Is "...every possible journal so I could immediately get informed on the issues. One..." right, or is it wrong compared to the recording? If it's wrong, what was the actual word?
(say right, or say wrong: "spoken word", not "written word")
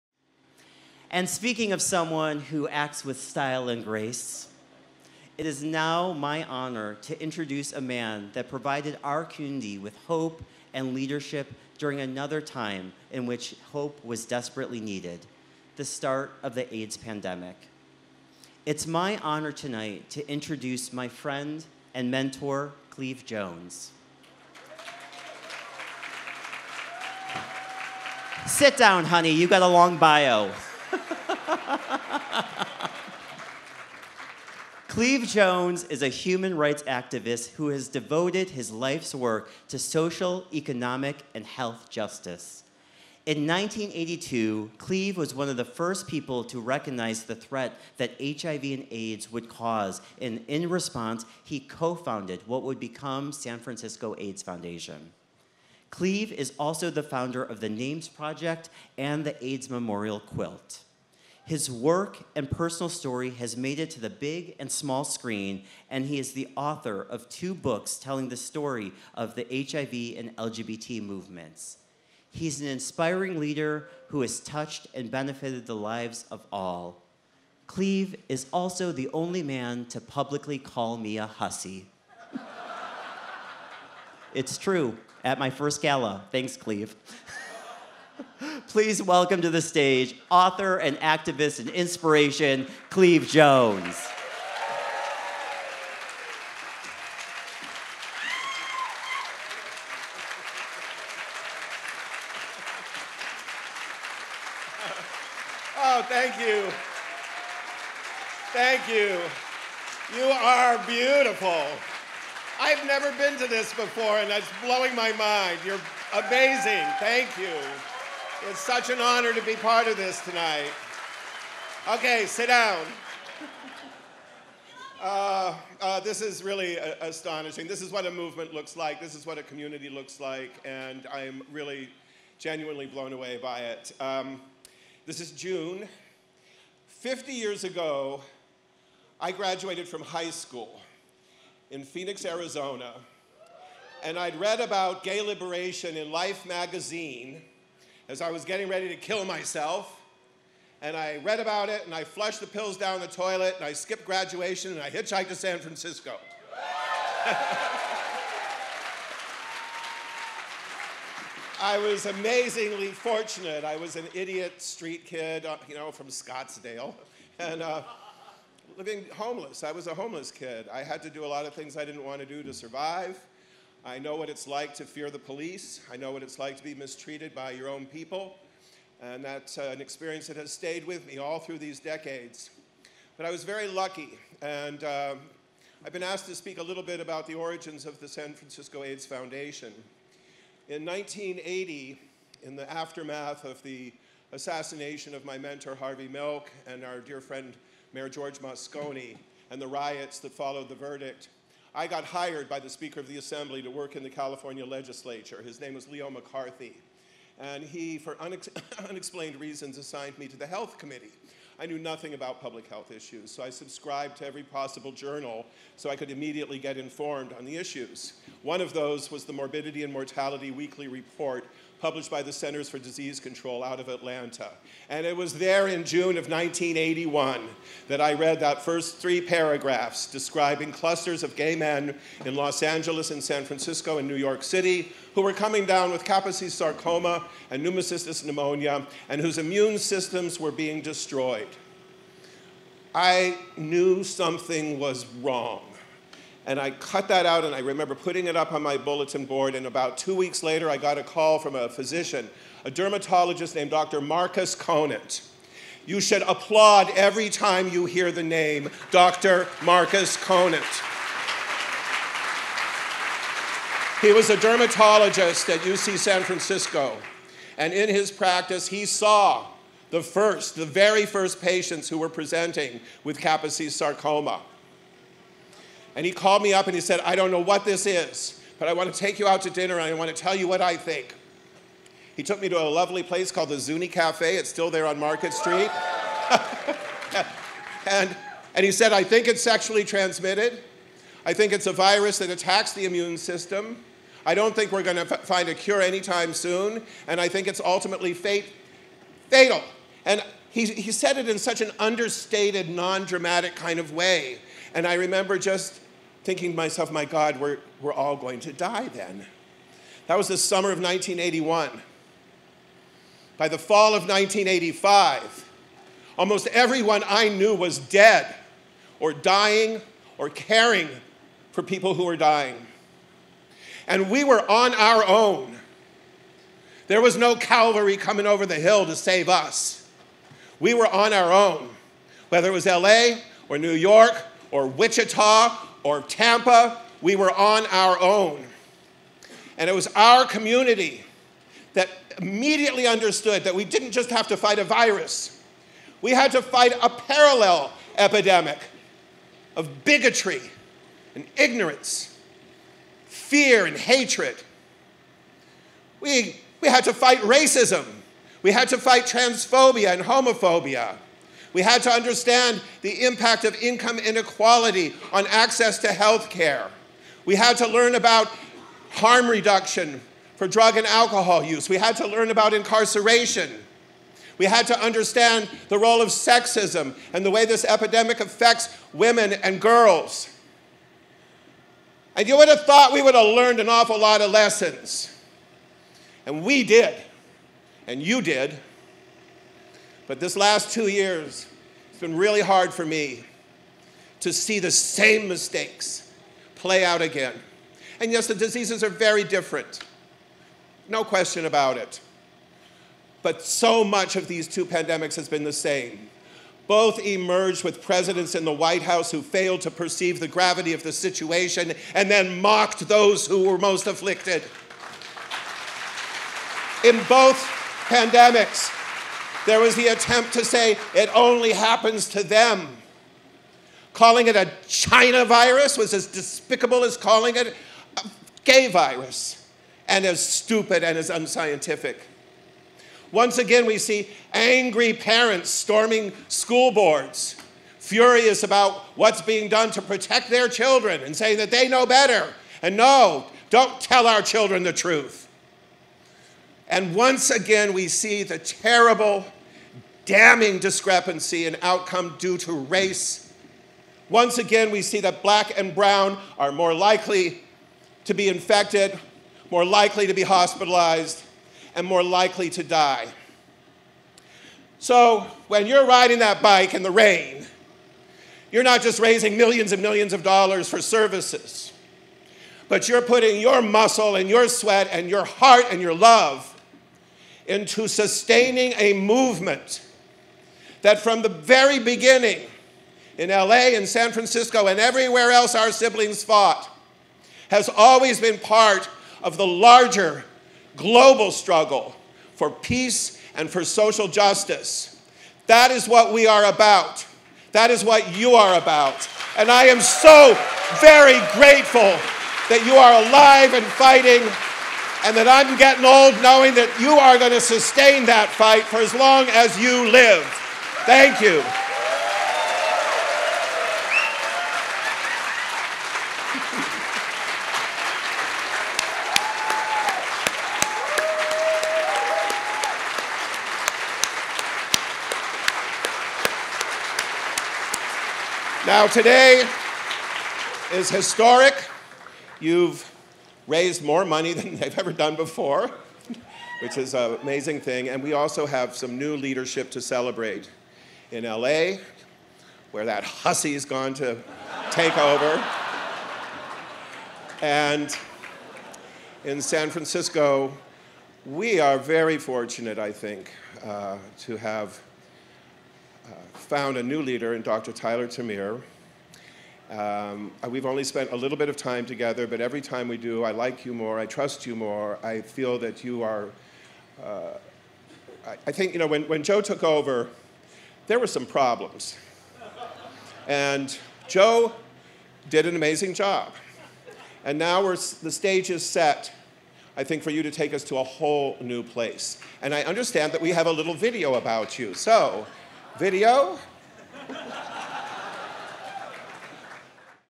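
right.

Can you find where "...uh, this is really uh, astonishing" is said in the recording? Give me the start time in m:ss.
2:05.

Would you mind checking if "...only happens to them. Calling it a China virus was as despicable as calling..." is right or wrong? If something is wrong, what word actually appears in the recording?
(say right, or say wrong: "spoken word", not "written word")
right.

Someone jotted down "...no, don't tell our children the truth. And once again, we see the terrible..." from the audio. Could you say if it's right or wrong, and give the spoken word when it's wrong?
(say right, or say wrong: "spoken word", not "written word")
right.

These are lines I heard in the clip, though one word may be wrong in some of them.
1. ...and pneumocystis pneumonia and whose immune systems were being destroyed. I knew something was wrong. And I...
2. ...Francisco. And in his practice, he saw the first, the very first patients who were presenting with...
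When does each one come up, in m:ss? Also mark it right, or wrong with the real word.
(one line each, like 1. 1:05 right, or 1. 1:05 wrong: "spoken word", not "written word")
1. 3:57 right
2. 4:26 right.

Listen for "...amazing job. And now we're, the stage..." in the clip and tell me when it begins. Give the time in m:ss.
9:35.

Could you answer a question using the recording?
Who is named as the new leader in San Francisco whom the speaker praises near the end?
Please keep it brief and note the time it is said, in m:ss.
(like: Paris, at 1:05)
Dr. Tyler TerMeer, at 9:17.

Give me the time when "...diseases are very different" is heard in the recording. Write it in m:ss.
6:38.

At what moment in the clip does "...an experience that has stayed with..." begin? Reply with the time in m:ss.
2:59.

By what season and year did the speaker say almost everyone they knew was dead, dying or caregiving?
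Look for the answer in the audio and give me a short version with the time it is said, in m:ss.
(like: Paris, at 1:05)
Fall of 1985, at 5:13.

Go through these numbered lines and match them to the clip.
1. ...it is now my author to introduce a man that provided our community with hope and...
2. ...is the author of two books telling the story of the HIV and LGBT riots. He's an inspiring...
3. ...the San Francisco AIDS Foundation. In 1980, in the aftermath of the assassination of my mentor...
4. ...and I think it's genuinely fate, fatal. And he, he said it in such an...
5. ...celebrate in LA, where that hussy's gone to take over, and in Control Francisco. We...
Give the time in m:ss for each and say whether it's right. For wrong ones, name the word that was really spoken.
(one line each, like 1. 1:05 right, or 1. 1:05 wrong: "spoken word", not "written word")
1. 0:05 wrong: "honor", not "author"
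2. 1:06 wrong: "movements", not "riots"
3. 3:07 right
4. 4:57 wrong: "ultimately", not "genuinely"
5. 8:59 wrong: "San", not "Control".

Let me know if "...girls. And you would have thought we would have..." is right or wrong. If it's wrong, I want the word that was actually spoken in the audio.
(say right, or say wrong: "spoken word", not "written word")
right.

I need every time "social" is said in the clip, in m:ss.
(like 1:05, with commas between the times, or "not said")
0:39, 8:13.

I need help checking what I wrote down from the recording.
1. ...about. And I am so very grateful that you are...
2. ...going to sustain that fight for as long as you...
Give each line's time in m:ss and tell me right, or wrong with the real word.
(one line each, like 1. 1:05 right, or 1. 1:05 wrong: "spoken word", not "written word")
1. 8:18 right
2. 8:27 right.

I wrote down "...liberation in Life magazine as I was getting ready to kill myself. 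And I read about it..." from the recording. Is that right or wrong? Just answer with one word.
right.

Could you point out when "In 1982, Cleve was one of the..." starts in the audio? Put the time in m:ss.
0:43.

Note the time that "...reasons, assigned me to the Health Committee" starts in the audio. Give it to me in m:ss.
3:29.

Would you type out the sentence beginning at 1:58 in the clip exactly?
It's such an honor to be part of this tonight.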